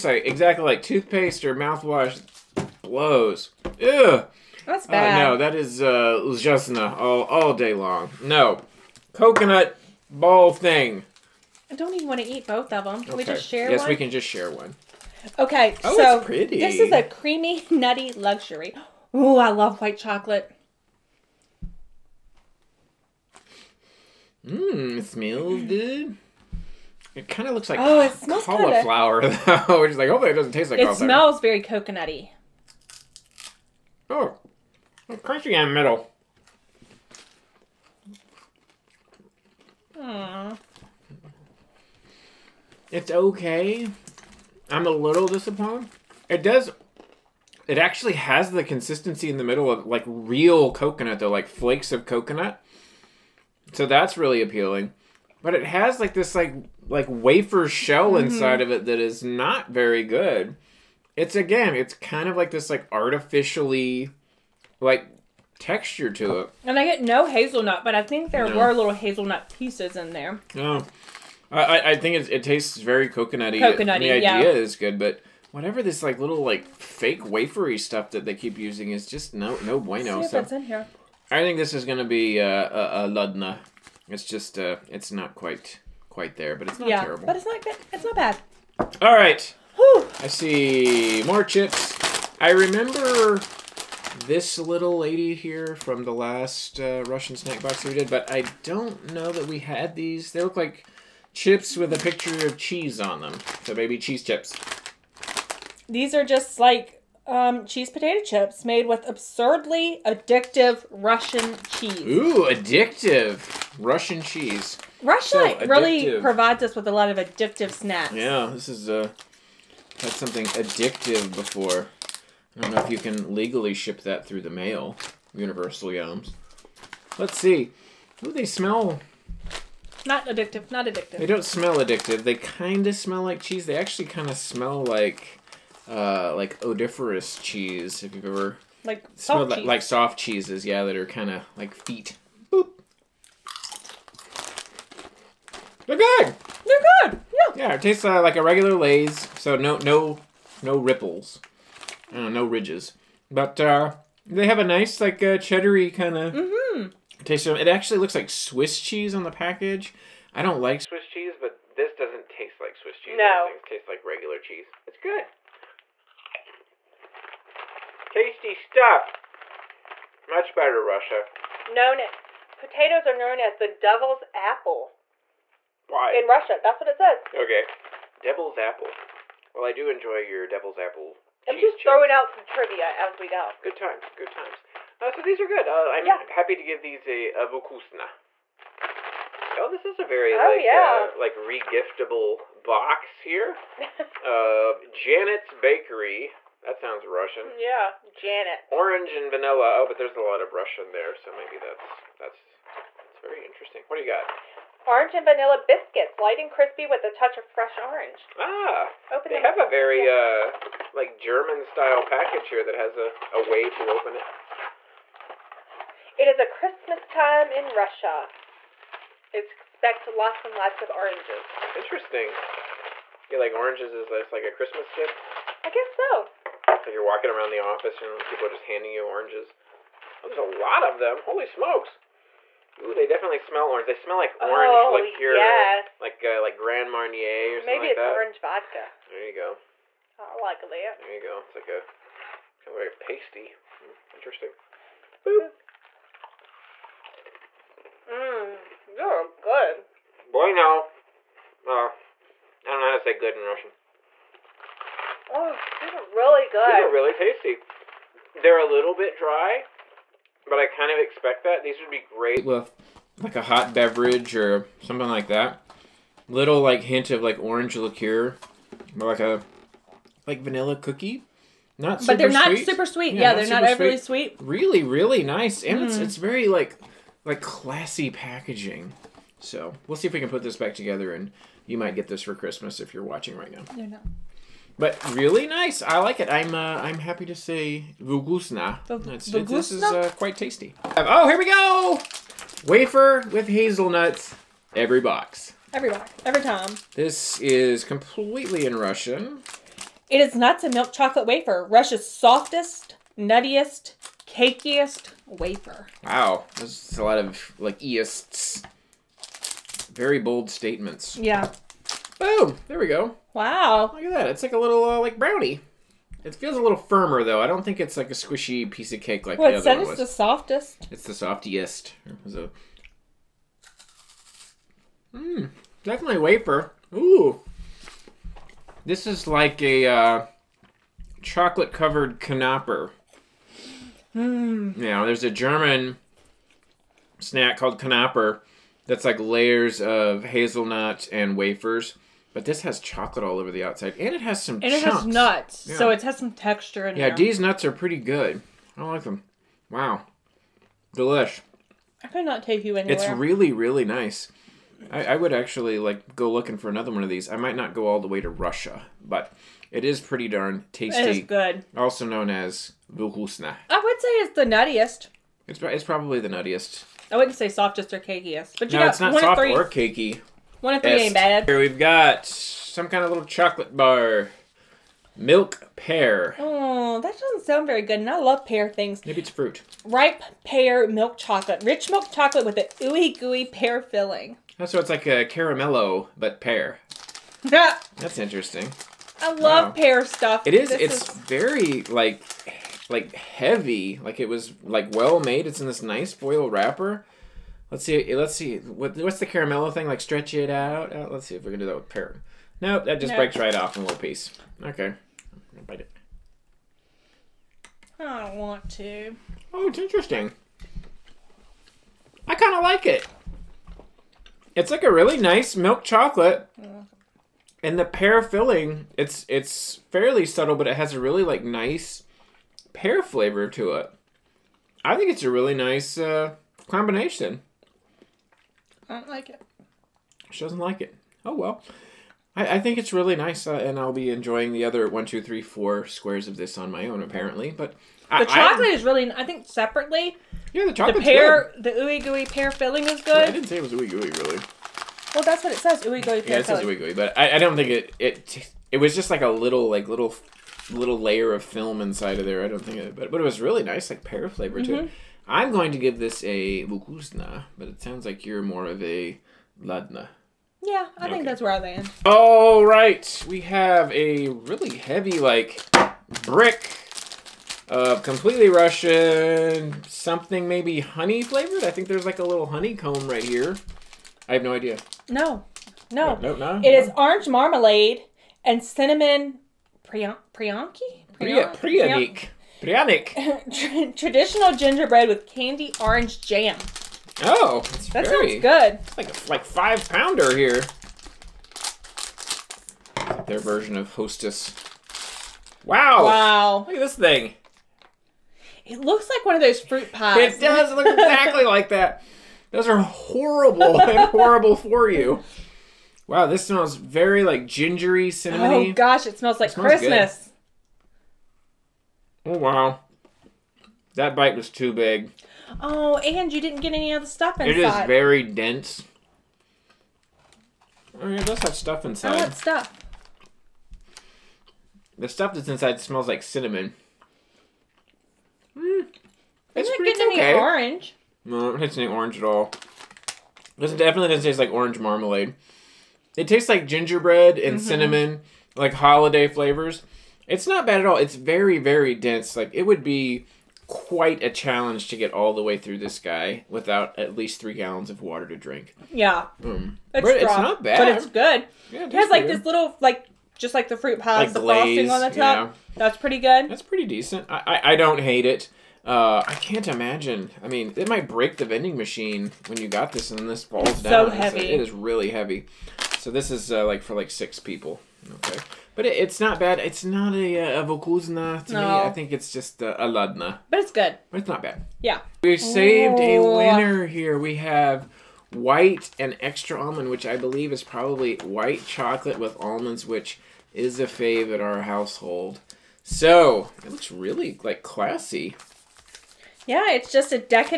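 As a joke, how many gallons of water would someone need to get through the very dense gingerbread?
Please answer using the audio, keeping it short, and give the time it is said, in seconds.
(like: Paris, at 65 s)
3, at 547 s.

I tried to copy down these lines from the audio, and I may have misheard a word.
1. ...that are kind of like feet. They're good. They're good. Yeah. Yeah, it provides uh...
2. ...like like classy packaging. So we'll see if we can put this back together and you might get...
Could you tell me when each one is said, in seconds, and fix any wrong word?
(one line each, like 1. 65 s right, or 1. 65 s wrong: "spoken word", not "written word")
1. 140 s wrong: "tastes", not "provides"
2. 276 s right.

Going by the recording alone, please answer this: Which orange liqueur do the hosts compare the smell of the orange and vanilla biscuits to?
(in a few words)
Grand Marnier.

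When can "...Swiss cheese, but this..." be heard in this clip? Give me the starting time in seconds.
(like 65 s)
160 s.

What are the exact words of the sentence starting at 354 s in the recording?
I, I would actually like go looking for another one of these.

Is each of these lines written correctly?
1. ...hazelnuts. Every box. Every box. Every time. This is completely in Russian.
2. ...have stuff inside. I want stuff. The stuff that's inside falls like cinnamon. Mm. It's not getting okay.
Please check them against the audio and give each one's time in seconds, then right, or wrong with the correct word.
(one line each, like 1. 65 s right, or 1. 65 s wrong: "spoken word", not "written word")
1. 293 s right
2. 521 s wrong: "smells", not "falls".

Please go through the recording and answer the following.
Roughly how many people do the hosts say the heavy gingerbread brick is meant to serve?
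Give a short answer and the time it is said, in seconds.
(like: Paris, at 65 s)
6, at 567 s.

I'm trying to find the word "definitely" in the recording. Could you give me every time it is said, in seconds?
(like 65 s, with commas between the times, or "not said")
233 s, 325 s, 533 s.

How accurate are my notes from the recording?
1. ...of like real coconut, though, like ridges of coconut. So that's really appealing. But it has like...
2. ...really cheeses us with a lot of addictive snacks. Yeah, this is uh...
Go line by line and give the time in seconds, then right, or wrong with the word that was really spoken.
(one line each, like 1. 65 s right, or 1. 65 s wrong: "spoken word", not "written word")
1. 49 s wrong: "flakes", not "ridges"
2. 115 s wrong: "provides", not "cheeses".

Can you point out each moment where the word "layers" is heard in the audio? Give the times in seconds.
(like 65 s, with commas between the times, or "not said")
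339 s, 450 s.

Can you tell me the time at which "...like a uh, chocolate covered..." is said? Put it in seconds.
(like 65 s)
329 s.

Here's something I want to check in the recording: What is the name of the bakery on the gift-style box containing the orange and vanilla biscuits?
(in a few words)
Janet's Bakery.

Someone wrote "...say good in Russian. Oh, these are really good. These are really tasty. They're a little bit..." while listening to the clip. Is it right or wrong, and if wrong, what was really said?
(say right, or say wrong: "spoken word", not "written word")
right.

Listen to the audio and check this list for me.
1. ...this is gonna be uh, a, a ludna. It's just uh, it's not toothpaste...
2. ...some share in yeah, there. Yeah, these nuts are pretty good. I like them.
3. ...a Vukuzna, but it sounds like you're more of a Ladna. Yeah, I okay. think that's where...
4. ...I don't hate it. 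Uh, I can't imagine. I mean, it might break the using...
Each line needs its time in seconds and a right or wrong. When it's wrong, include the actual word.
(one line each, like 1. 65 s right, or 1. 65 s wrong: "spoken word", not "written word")
1. 81 s wrong: "quite", not "toothpaste"
2. 346 s wrong: "texture", not "share"
3. 456 s right
4. 557 s wrong: "vending", not "using".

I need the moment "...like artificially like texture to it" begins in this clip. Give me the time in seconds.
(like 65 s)
62 s.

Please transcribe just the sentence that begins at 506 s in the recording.
Wow, this smells very like gingery, cinnamony.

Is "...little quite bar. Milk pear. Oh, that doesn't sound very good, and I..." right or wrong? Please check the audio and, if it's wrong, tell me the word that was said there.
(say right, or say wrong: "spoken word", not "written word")
wrong: "chocolate", not "quite".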